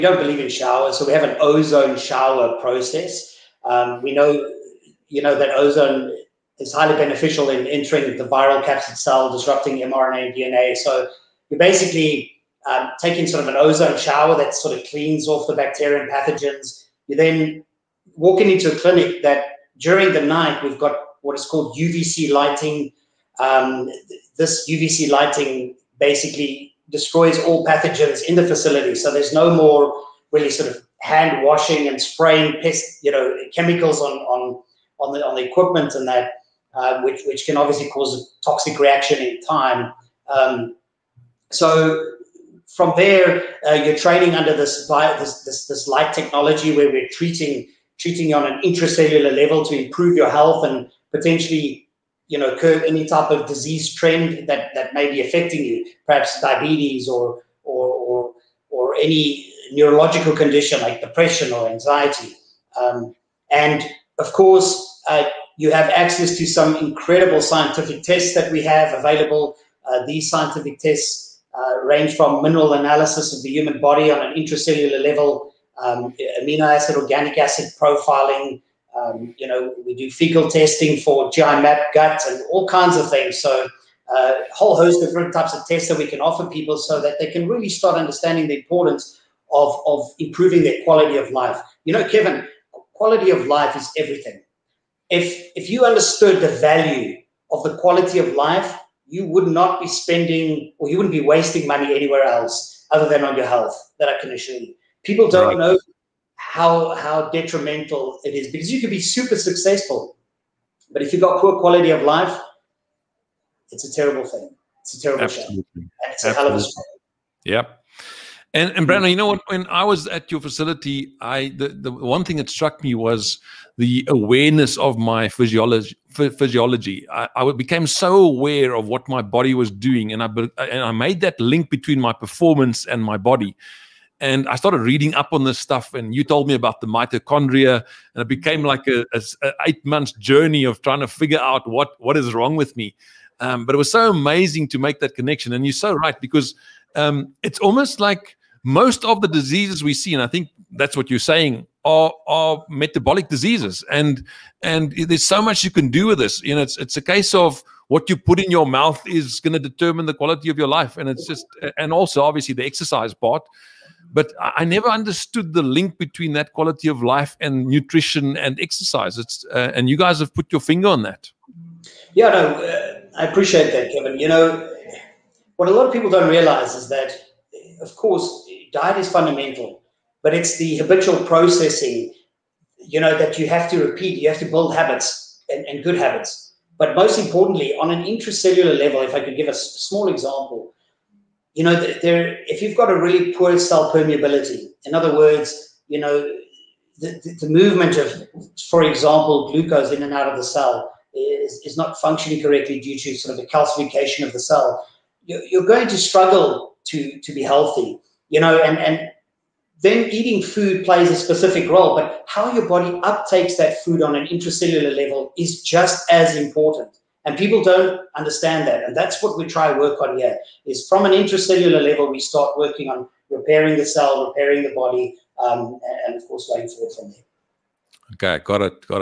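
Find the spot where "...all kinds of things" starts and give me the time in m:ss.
1:22.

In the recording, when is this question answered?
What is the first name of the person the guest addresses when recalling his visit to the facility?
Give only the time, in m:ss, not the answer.
1:58.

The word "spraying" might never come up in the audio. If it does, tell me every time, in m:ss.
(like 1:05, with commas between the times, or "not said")
0:32.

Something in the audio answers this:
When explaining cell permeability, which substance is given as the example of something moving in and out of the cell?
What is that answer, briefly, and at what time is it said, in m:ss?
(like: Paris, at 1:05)
glucose, at 3:19.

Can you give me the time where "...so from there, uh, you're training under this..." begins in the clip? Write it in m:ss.
0:41.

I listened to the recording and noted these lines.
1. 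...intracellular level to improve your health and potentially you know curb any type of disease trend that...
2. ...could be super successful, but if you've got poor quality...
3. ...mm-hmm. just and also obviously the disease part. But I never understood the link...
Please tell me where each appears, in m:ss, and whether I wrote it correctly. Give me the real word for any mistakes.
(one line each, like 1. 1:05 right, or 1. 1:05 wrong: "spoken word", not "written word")
1. 0:48 right
2. 1:48 right
3. 2:41 wrong: "exercise", not "disease".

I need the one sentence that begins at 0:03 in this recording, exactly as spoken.
Um, we know you know that ozone is highly beneficial in entering the viral capsid cell, disrupting mRNA and DNA.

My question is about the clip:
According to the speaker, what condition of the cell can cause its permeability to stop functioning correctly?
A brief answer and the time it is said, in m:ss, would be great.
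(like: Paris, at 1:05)
calcification, at 3:23.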